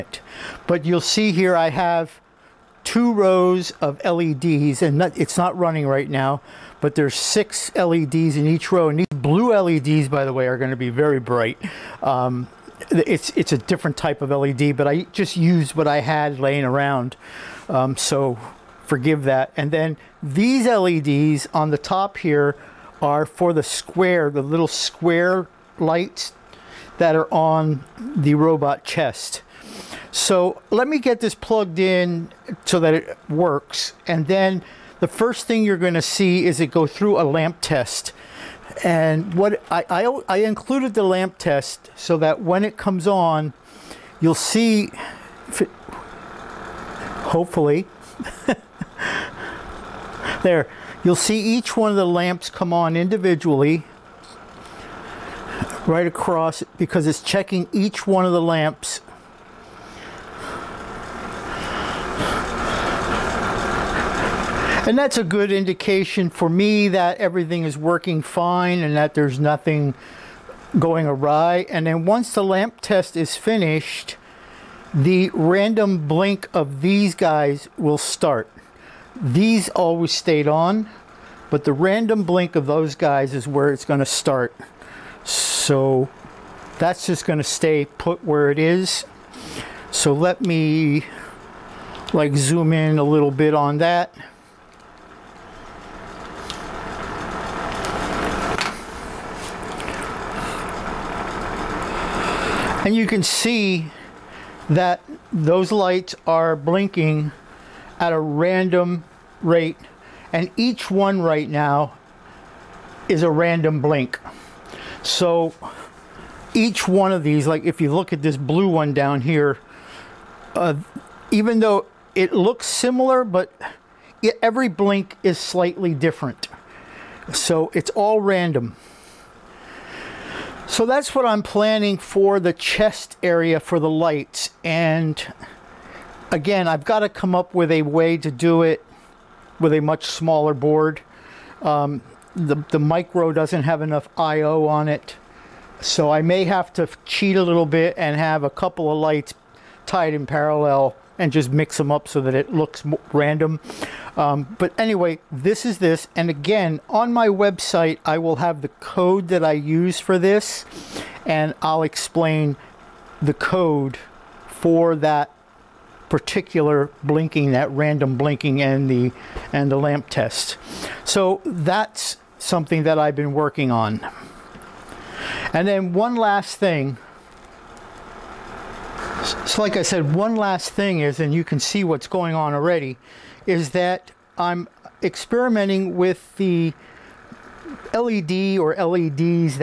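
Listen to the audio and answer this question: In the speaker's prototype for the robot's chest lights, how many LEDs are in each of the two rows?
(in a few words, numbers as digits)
6.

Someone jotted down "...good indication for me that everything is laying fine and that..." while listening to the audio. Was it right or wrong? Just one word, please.
wrong.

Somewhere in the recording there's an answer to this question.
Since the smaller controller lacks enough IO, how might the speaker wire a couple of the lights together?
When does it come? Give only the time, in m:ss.
2:30.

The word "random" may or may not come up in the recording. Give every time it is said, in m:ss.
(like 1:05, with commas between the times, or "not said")
1:15, 1:21, 1:48, 1:53, 2:08, 2:33, 2:47.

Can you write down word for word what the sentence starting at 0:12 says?
Um, it's it's a different type of LED, but I just used what I had laying around.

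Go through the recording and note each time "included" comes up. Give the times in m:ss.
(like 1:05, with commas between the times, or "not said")
0:40.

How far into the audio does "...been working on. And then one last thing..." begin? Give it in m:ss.
2:53.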